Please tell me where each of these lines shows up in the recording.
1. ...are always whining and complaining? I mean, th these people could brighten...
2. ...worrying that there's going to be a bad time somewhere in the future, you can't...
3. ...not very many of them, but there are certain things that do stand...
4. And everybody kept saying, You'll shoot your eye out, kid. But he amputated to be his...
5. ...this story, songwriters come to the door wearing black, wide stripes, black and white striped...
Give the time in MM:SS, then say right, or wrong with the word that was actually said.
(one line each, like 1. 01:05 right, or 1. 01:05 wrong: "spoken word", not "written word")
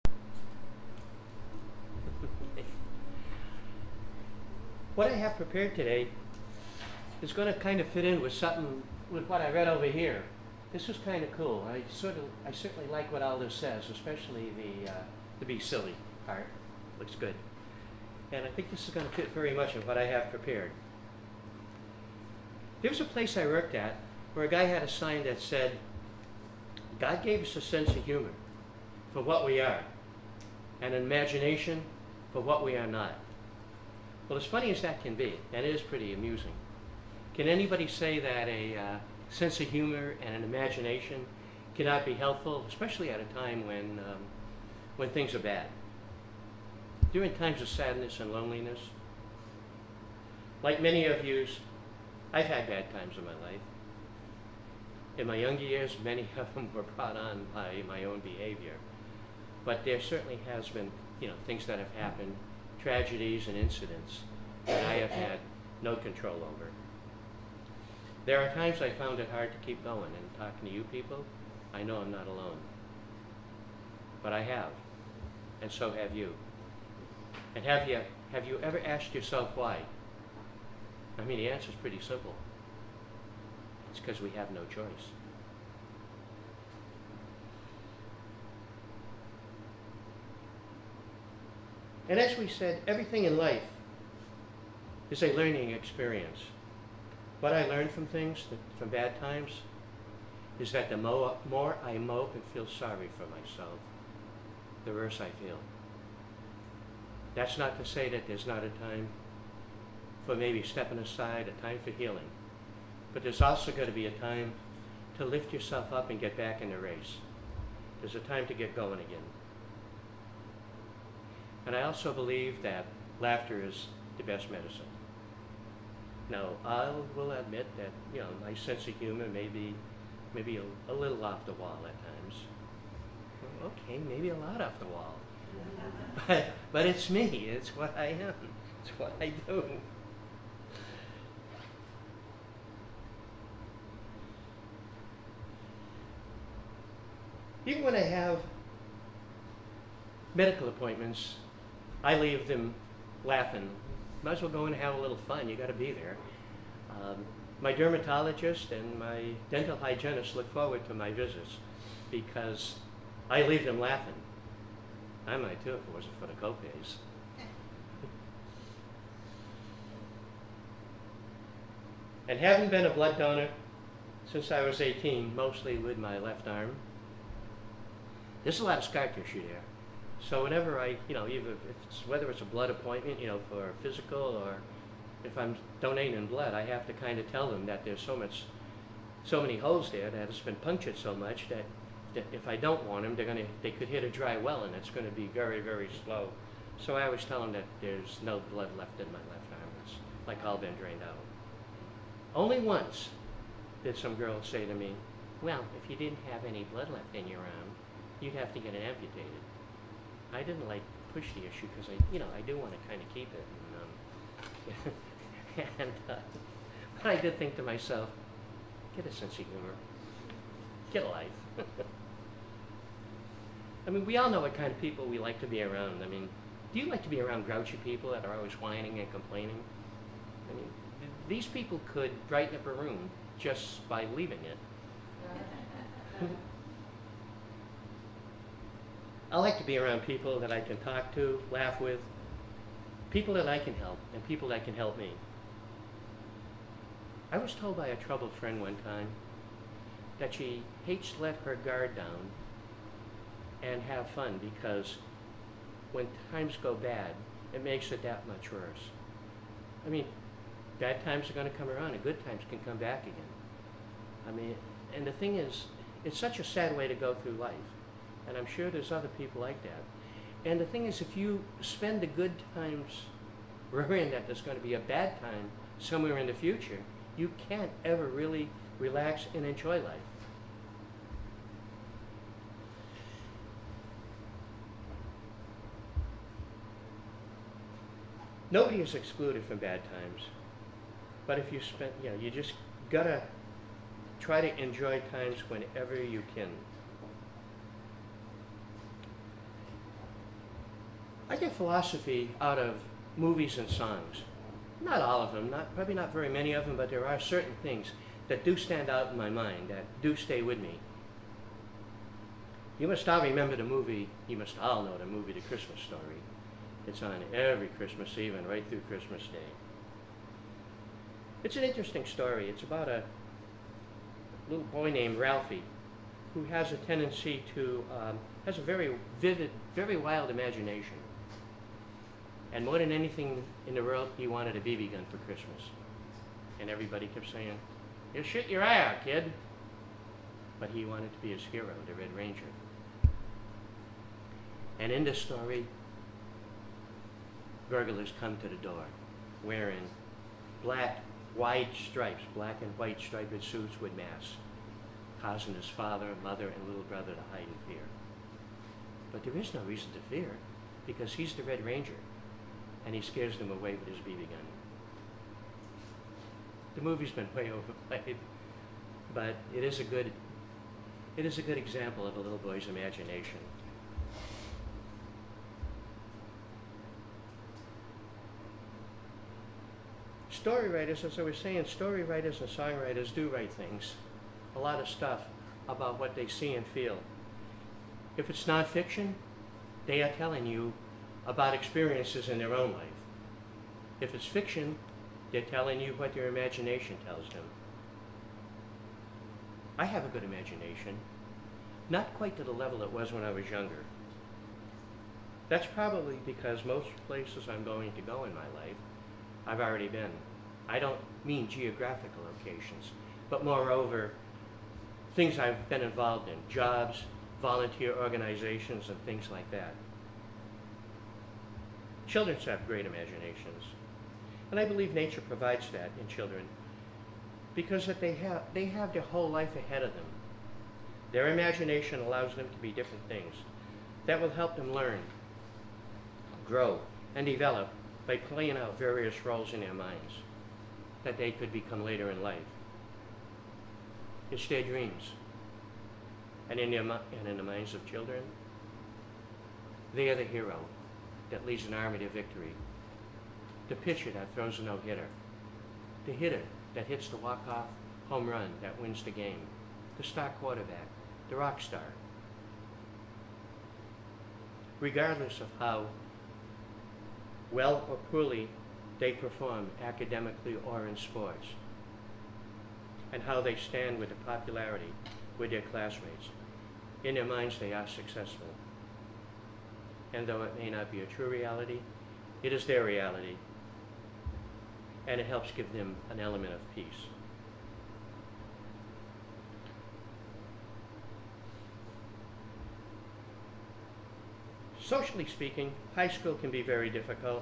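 1. 03:48 right
2. 04:33 right
3. 05:05 right
4. 05:36 wrong: "wanted", not "amputated"
5. 05:45 wrong: "burglars", not "songwriters".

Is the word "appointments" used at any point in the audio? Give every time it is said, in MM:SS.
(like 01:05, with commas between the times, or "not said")
02:30, 03:02.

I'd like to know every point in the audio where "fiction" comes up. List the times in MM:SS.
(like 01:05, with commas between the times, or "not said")
06:28, 06:34.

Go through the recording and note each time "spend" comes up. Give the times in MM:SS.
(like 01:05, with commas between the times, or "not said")
04:31, 04:51.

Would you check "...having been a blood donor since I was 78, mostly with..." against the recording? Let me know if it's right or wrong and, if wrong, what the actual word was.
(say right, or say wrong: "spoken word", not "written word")
wrong: "18", not "78".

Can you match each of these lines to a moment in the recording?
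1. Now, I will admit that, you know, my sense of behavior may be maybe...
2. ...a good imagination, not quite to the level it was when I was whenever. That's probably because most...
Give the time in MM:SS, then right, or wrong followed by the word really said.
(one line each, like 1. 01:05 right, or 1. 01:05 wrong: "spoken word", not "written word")
1. 02:06 wrong: "humor", not "behavior"
2. 06:40 wrong: "younger", not "whenever".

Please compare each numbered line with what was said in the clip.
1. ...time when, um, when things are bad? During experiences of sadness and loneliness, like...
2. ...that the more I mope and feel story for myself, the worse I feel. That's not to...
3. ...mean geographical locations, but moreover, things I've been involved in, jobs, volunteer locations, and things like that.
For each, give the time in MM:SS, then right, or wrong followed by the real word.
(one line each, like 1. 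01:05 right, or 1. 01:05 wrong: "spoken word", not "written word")
1. 00:43 wrong: "times", not "experiences"
2. 01:40 wrong: "sorry", not "story"
3. 06:51 wrong: "organizations", not "locations".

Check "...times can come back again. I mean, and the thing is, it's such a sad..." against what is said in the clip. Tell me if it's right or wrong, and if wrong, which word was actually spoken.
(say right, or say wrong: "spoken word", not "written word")
right.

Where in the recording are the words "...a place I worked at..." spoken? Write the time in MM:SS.
00:23.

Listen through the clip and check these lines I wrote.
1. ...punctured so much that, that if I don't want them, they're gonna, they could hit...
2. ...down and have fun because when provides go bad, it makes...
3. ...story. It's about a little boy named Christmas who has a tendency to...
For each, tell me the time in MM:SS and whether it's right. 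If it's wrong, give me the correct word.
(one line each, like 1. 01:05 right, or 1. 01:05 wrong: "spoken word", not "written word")
1. 03:10 right
2. 04:11 wrong: "times", not "provides"
3. 05:22 wrong: "Ralphie", not "Christmas".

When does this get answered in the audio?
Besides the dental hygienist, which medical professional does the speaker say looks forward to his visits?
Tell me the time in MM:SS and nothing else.
02:37.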